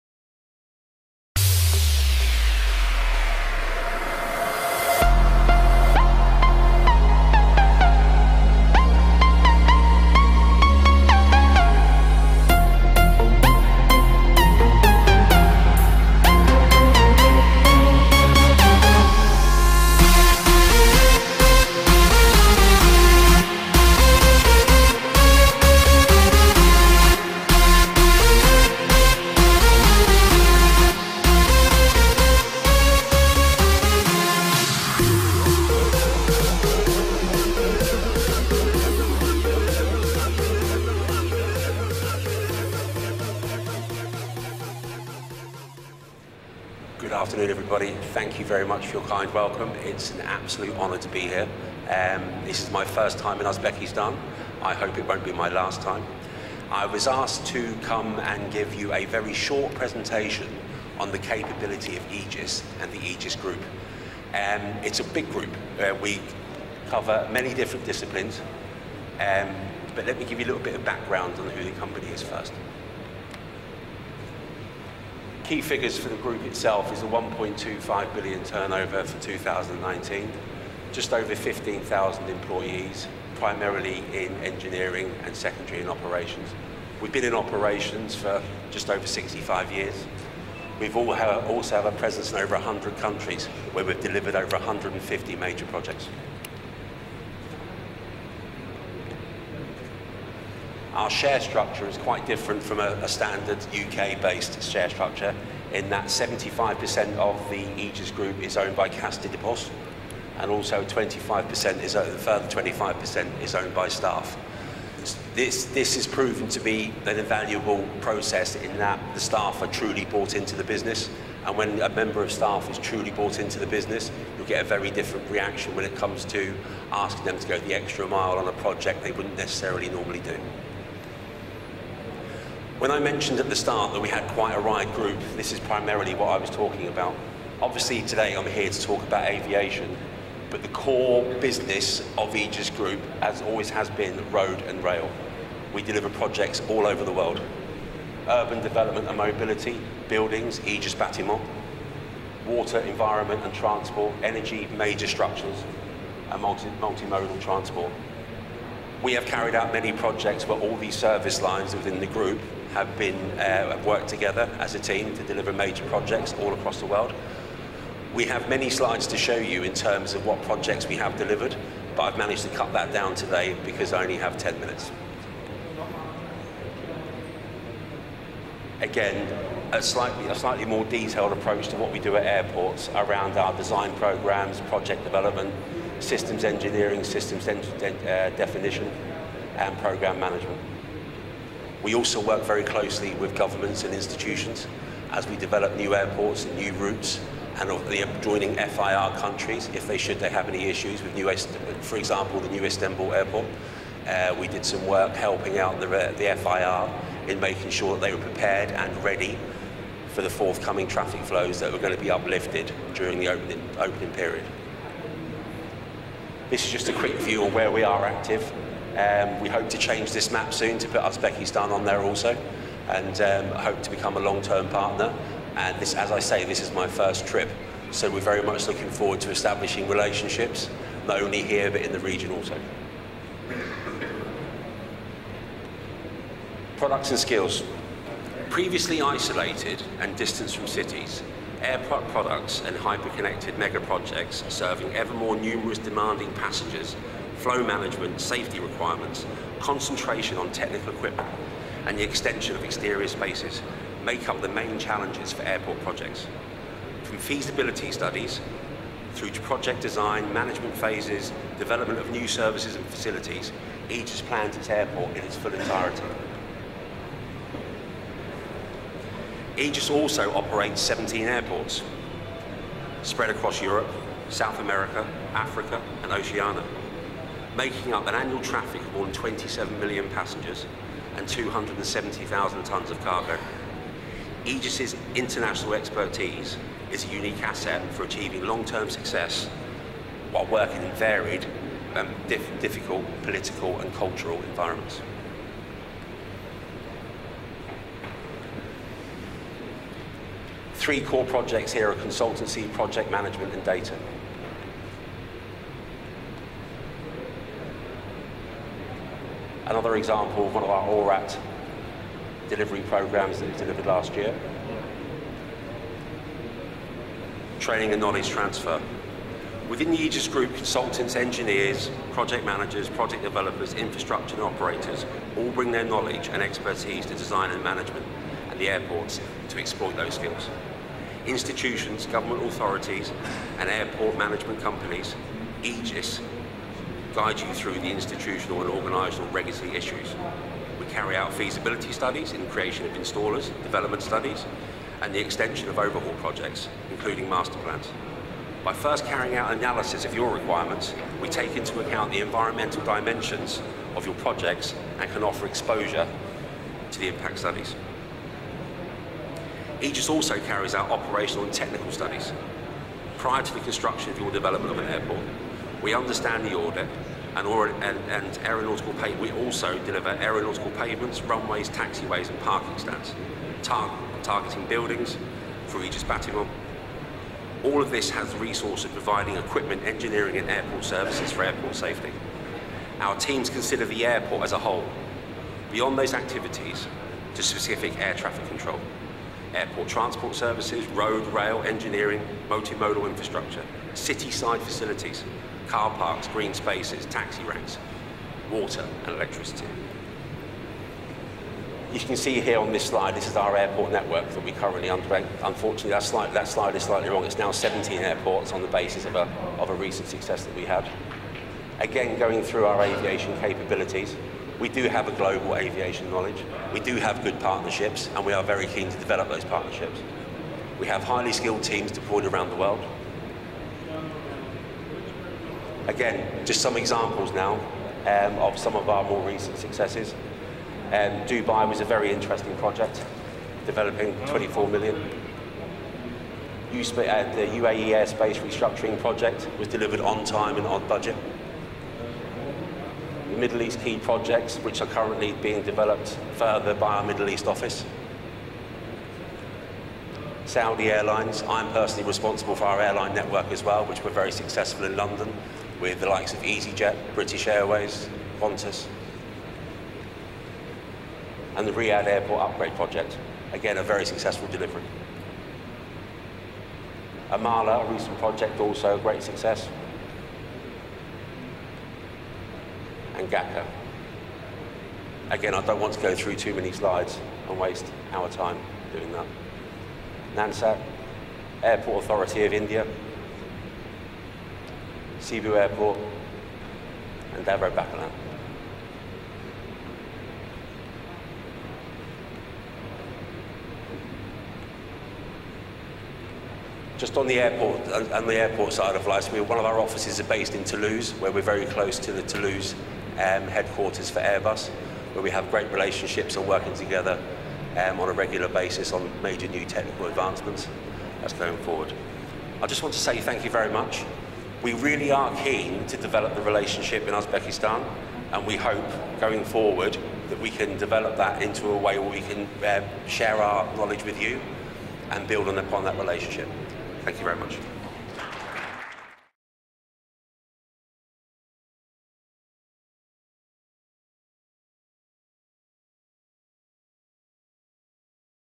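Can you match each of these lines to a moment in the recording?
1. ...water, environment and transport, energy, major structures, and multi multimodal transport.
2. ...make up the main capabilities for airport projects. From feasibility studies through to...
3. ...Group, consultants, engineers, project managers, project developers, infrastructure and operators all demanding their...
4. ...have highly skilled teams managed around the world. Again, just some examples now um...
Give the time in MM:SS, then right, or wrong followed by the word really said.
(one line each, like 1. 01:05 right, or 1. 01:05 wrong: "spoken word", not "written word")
1. 02:32 right
2. 04:14 wrong: "challenges", not "capabilities"
3. 05:20 wrong: "bring", not "demanding"
4. 07:00 wrong: "deployed", not "managed".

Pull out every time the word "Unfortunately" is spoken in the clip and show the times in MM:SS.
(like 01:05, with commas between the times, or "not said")
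06:45.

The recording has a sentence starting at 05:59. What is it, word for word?
Egis also carries out operational and technical studies.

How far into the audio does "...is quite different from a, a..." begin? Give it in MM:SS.
01:41.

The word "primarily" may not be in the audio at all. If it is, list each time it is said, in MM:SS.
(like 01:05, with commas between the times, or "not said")
01:23, 02:15.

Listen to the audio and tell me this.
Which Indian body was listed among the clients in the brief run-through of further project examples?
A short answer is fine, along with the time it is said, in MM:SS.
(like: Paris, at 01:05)
Airport Authority of India, at 08:01.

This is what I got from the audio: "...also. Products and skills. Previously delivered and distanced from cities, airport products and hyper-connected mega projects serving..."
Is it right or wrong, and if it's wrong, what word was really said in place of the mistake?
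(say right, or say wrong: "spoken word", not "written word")
wrong: "isolated", not "delivered".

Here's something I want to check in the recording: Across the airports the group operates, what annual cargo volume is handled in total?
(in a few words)
270,000 tonnes.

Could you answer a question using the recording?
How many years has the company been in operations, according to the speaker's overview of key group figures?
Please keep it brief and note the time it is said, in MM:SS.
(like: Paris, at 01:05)
65 years, at 01:29.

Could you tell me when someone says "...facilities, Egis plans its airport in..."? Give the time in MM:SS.
04:22.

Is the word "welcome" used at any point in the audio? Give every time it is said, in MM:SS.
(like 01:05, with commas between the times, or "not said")
00:49.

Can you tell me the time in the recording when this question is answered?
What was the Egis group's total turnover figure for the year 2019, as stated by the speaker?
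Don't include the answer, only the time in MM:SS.
01:17.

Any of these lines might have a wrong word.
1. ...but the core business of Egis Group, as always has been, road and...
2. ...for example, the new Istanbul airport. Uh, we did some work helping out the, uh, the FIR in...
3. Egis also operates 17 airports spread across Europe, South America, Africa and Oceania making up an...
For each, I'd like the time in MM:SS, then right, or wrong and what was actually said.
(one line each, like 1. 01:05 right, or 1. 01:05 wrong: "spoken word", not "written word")
1. 02:20 right
2. 03:21 right
3. 04:29 right.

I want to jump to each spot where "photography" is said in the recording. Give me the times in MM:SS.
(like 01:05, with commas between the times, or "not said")
not said.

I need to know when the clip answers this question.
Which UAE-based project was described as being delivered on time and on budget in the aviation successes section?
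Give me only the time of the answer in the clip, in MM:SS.
07:17.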